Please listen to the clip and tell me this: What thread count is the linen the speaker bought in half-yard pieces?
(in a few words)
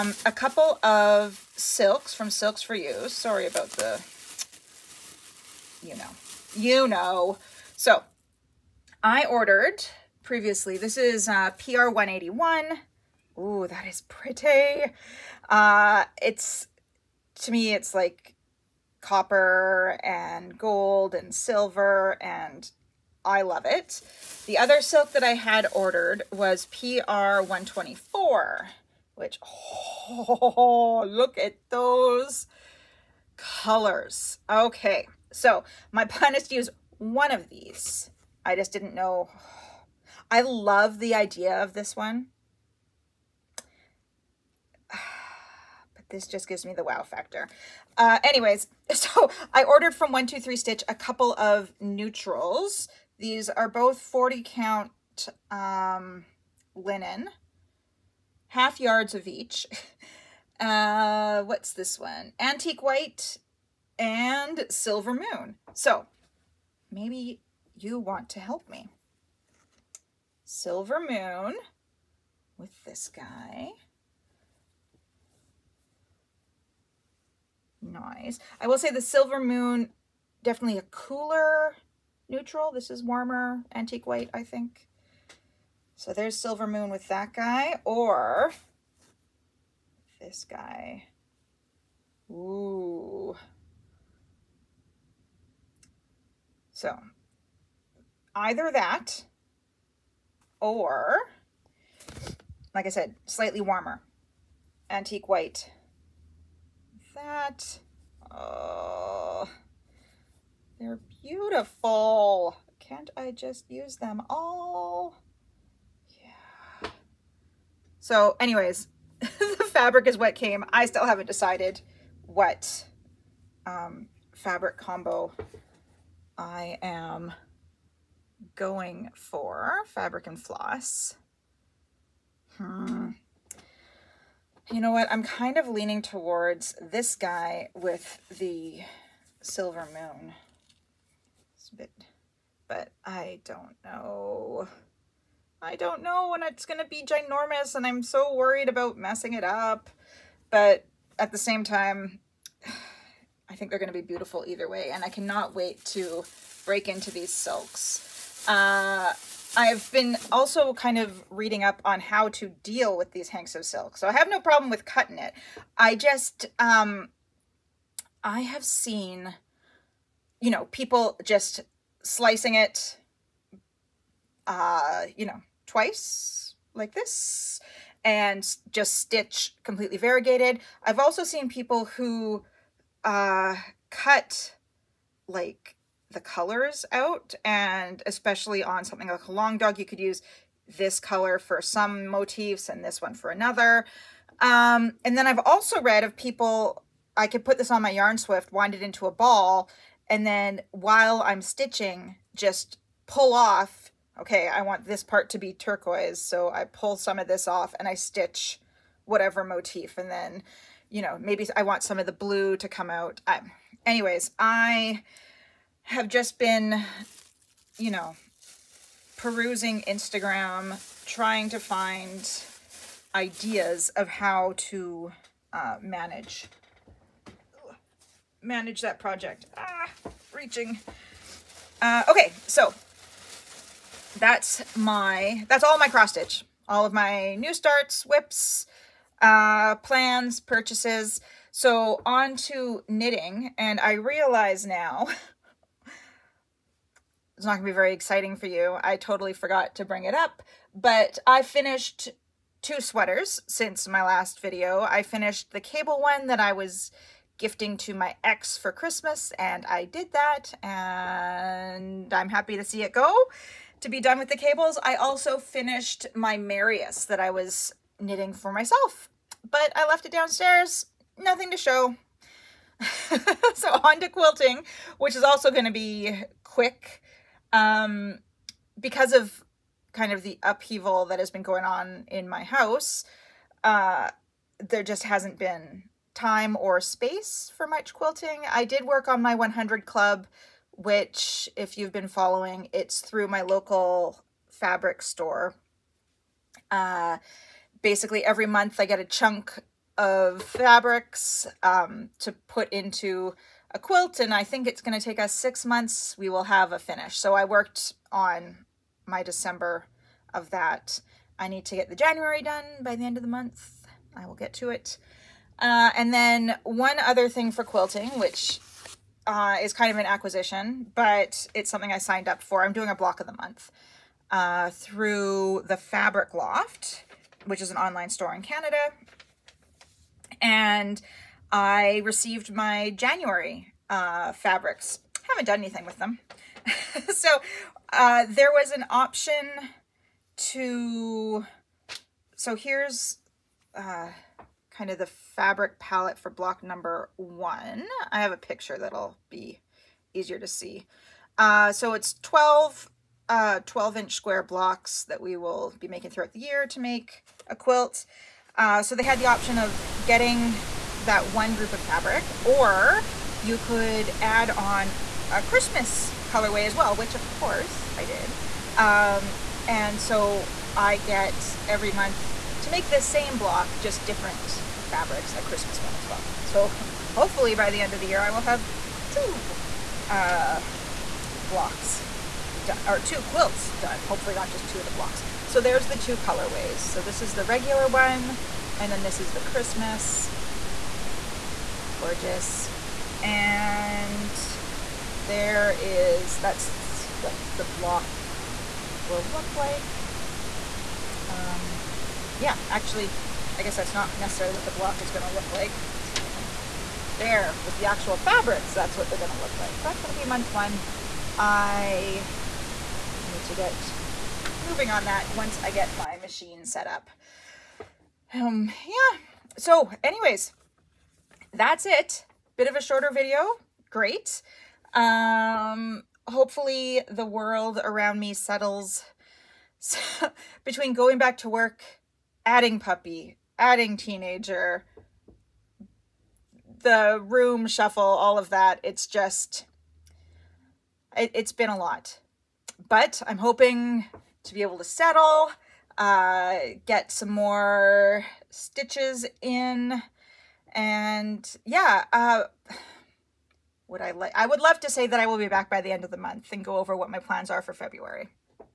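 40 count.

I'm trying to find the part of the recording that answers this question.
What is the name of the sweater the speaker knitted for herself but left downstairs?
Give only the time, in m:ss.
4:26.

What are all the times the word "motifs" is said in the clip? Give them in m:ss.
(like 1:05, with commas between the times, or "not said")
3:12, 3:29.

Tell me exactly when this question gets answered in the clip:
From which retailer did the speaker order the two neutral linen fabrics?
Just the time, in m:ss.
0:50.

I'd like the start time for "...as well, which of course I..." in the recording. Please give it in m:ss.
6:06.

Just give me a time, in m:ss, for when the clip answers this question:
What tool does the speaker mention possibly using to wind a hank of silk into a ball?
3:17.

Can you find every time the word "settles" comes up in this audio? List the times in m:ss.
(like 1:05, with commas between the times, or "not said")
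7:08, 7:24.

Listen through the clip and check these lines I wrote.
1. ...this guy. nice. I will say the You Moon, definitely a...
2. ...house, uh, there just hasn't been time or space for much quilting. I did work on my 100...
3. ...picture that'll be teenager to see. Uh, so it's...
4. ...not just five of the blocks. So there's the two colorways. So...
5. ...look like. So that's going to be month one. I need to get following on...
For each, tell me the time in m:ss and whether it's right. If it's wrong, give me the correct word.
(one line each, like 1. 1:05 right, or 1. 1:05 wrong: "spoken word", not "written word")
1. 1:12 wrong: "Silver", not "You"
2. 4:42 right
3. 5:48 wrong: "easier", not "teenager"
4. 6:24 wrong: "two", not "five"
5. 6:49 wrong: "moving", not "following".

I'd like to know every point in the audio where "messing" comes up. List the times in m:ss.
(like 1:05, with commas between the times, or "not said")
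2:28.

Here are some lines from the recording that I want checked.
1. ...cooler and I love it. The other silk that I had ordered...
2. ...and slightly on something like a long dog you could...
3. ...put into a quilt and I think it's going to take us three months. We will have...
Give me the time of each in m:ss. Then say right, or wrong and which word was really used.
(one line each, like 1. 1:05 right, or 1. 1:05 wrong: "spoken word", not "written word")
1. 0:21 wrong: "silver", not "cooler"
2. 3:07 wrong: "especially", not "slightly"
3. 5:02 wrong: "six", not "three".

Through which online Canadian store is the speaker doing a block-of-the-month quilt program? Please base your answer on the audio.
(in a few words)
the Fabric Loft.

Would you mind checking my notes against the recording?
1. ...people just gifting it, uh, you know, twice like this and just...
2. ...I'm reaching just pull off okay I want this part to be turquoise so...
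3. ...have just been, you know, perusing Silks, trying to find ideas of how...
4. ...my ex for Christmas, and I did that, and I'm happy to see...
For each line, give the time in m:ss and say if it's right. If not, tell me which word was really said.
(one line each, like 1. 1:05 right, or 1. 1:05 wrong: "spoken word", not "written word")
1. 2:50 wrong: "slicing", not "gifting"
2. 3:21 wrong: "stitching", not "reaching"
3. 3:35 wrong: "Instagram", not "Silks"
4. 4:17 right.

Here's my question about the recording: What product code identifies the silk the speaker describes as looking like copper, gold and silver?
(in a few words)
PR 181.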